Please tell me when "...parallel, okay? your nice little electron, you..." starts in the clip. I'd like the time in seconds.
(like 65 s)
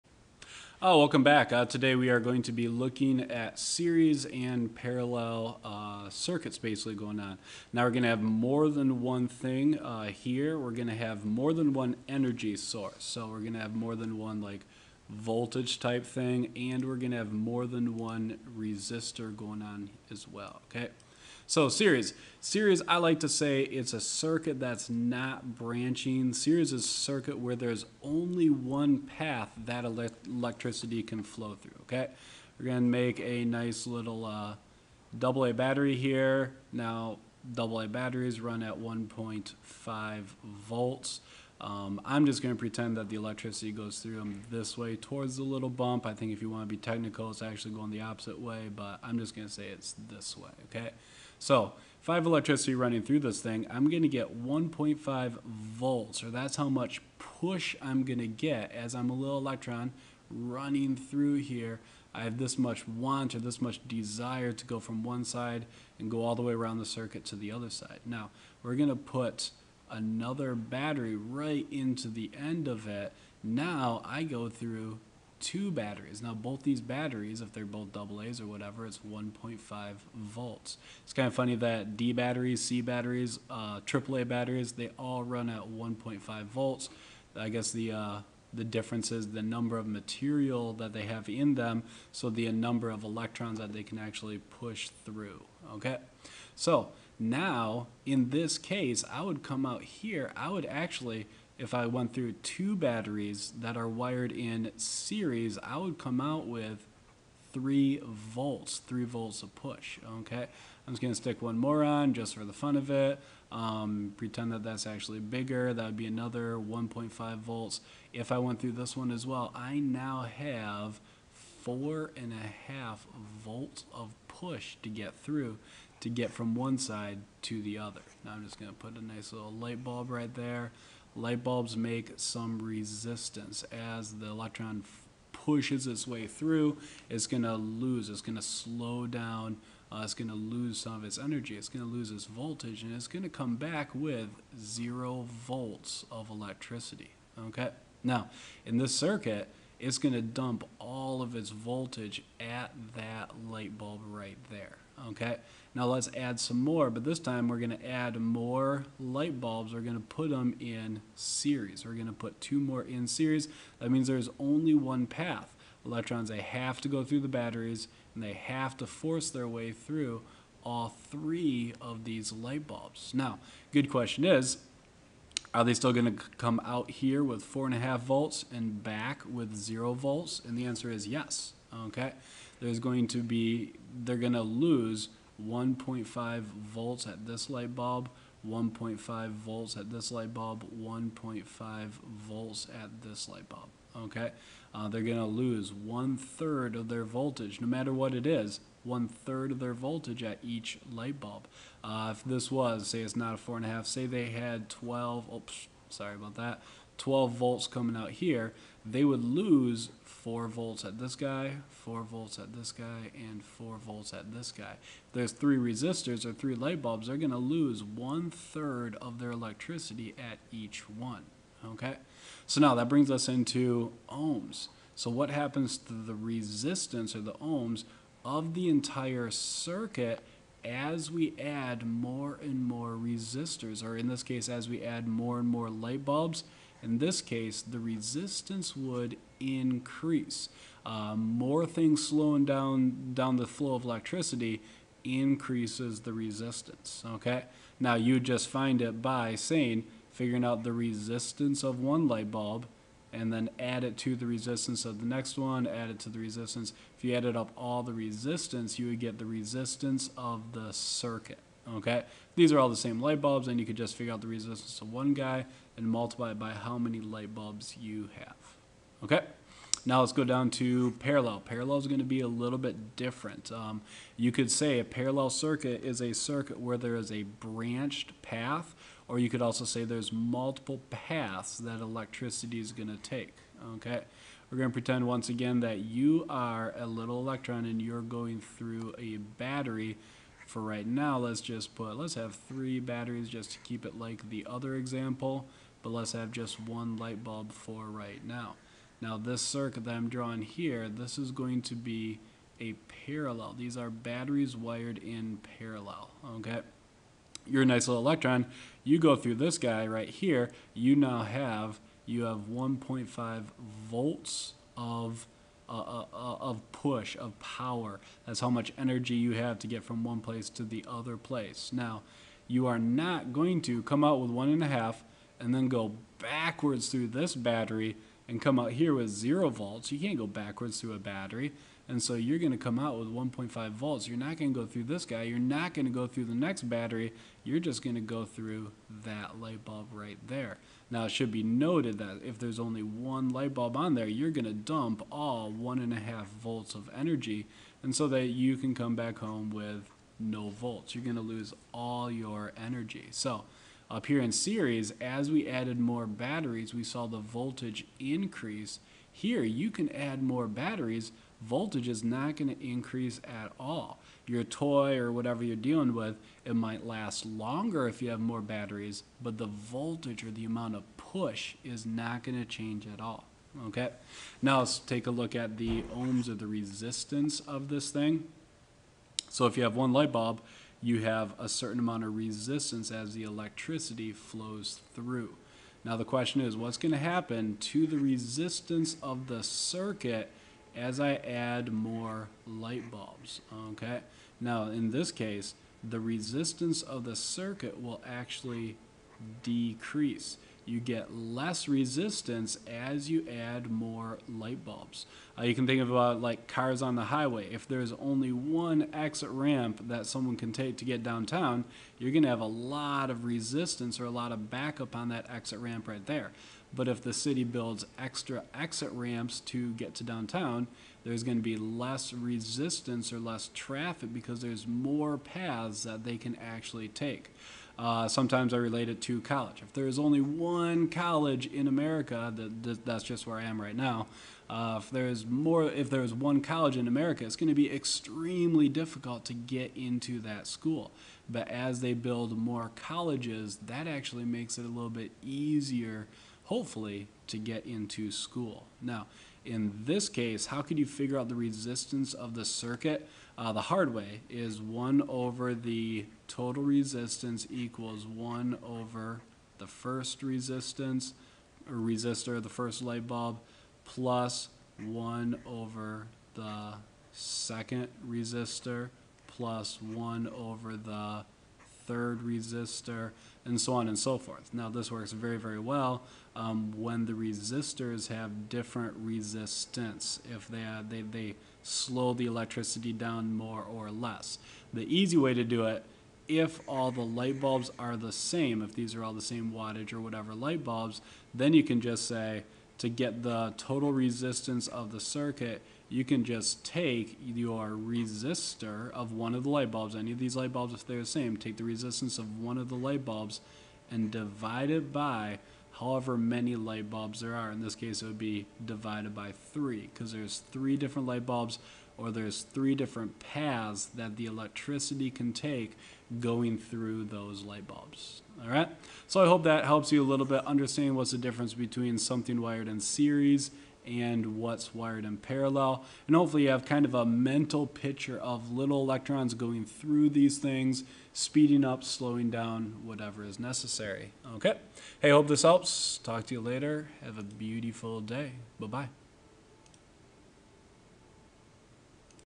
305 s.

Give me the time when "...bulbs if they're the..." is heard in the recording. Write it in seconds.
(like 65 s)
500 s.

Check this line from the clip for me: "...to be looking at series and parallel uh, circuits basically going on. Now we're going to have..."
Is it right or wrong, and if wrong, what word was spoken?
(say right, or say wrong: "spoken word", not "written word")
right.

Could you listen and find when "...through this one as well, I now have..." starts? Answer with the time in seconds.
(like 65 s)
118 s.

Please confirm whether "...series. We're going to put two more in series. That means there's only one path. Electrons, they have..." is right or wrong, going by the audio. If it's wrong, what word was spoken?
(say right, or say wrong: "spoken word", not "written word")
right.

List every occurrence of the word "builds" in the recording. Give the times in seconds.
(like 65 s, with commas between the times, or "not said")
417 s, 441 s.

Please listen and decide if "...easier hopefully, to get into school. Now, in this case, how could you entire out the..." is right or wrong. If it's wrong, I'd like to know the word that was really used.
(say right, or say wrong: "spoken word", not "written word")
wrong: "figure", not "entire".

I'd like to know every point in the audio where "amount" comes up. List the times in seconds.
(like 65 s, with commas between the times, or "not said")
370 s, 381 s.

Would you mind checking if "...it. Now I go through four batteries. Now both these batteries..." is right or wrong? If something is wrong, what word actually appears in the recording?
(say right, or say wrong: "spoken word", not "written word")
wrong: "two", not "four".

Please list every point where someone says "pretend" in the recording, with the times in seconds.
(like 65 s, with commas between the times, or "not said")
42 s, 114 s, 284 s.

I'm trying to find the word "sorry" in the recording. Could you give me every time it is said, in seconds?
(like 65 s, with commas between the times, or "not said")
205 s.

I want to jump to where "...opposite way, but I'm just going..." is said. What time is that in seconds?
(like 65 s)
48 s.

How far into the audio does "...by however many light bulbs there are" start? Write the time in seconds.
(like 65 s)
504 s.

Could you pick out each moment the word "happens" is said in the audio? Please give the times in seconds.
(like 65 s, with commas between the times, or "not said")
225 s, 386 s.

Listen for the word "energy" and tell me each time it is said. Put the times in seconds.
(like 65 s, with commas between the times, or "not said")
12 s, 141 s, 318 s, 346 s, 352 s.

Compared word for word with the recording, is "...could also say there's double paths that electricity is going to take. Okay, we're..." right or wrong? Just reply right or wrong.
wrong.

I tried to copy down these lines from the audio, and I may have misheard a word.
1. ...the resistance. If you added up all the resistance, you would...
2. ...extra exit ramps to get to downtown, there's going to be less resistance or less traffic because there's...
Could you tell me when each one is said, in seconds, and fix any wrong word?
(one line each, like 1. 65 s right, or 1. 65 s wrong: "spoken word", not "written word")
1. 256 s right
2. 417 s right.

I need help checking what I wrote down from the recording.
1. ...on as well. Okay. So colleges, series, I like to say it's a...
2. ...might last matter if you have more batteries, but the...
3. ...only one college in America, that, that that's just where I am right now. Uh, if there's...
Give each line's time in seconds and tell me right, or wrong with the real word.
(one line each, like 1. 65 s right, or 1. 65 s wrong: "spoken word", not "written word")
1. 19 s wrong: "series", not "colleges"
2. 366 s wrong: "longer", not "matter"
3. 429 s right.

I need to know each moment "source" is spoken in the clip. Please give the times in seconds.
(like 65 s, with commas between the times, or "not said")
12 s.